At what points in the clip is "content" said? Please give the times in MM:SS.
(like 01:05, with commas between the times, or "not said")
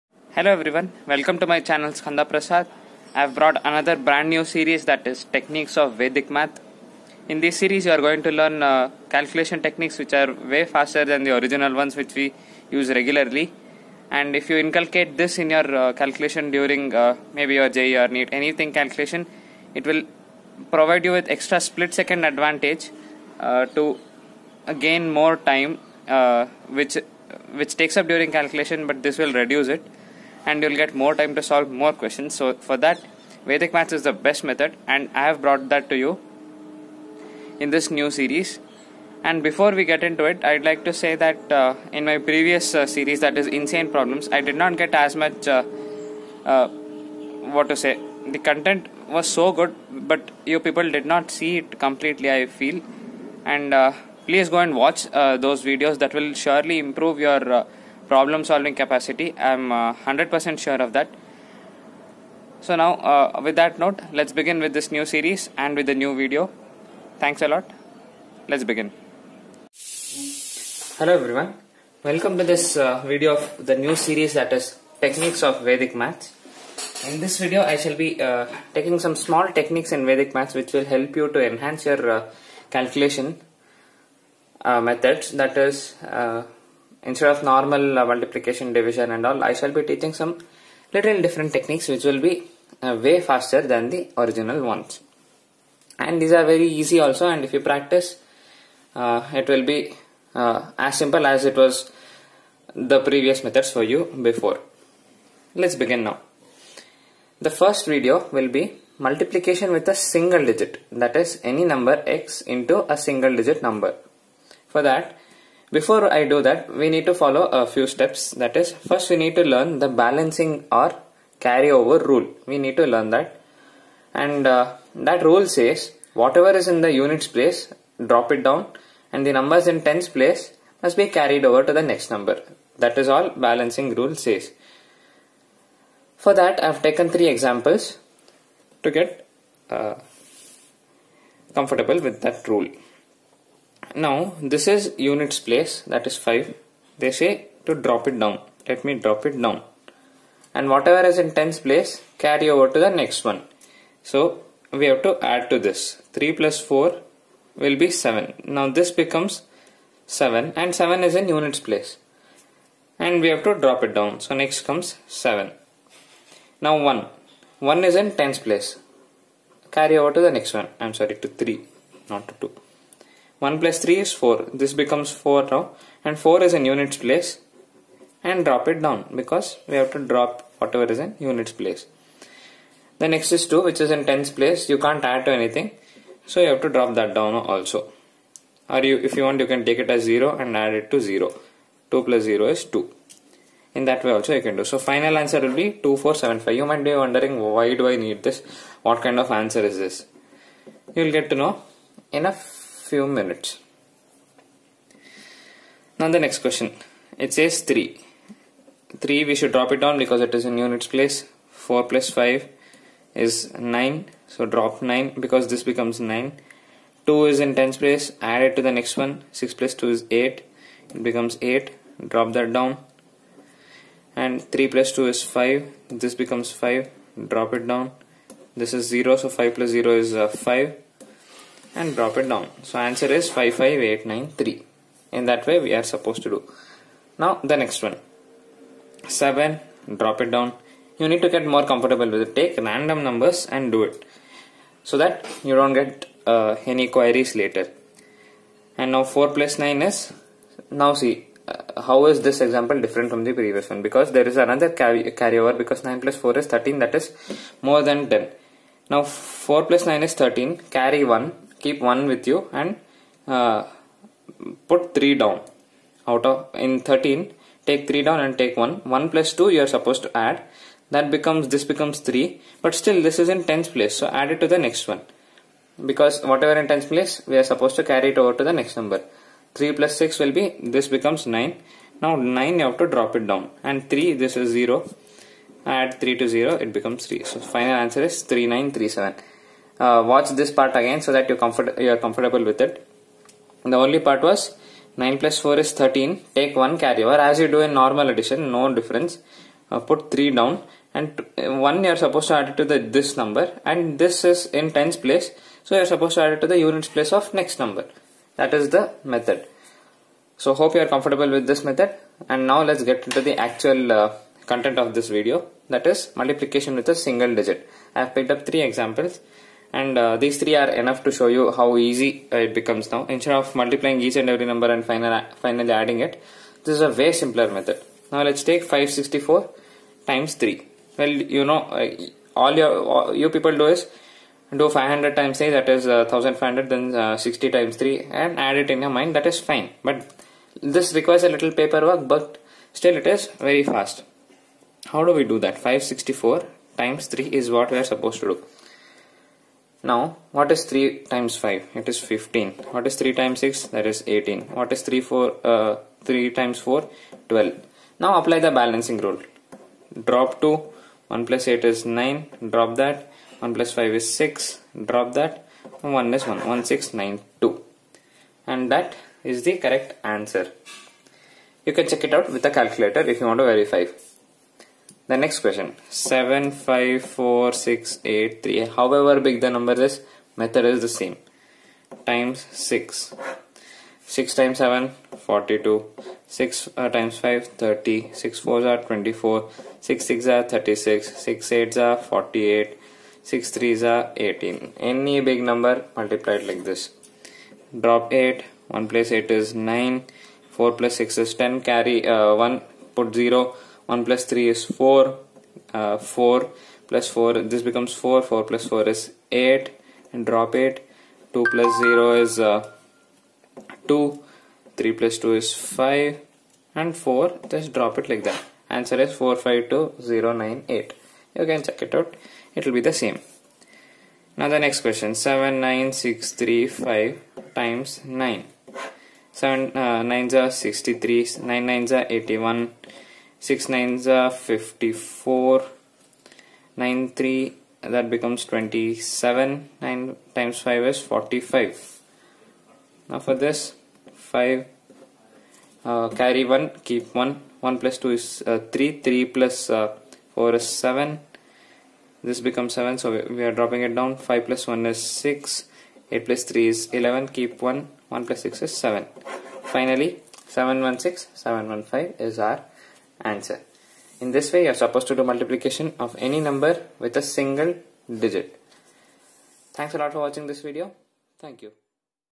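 00:48, 05:14.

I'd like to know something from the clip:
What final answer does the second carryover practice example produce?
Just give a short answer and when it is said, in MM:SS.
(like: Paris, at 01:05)
55893, at 03:53.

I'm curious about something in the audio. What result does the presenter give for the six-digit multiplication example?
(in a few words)
452098.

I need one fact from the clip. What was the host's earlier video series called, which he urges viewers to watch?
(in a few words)
Insane Problems.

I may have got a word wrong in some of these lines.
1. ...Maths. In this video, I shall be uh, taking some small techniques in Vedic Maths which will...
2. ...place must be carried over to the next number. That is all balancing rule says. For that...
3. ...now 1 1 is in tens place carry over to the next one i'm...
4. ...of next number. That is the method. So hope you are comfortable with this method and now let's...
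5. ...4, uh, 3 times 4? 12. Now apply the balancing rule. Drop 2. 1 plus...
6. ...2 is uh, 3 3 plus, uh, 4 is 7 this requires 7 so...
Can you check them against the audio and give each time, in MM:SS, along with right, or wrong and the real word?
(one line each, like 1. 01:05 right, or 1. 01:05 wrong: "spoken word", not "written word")
1. 01:15 right
2. 02:10 right
3. 02:46 right
4. 05:07 right
5. 05:55 right
6. 07:28 wrong: "becomes", not "requires".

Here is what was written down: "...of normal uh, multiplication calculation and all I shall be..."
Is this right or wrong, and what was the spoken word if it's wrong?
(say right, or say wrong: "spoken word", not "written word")
wrong: "division", not "calculation".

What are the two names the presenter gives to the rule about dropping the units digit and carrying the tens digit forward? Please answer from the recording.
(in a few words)
balancing or carryover rule.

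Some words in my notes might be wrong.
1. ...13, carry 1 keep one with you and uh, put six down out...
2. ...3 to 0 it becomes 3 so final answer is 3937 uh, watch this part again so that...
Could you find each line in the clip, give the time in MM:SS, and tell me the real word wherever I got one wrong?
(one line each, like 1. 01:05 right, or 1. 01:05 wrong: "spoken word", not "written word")
1. 04:20 wrong: "three", not "six"
2. 04:46 right.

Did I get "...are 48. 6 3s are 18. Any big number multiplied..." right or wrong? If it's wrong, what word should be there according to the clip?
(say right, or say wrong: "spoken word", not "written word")
right.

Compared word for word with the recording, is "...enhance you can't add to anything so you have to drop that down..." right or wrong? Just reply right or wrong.
wrong.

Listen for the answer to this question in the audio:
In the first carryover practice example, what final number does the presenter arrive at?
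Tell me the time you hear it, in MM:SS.
03:15.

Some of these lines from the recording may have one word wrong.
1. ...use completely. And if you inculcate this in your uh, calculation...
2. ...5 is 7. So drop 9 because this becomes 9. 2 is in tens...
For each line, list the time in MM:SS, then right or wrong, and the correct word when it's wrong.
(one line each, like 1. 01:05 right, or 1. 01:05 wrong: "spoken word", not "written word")
1. 00:12 wrong: "regularly", not "completely"
2. 03:32 wrong: "9", not "7".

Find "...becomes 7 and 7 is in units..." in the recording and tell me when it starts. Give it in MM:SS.
02:38.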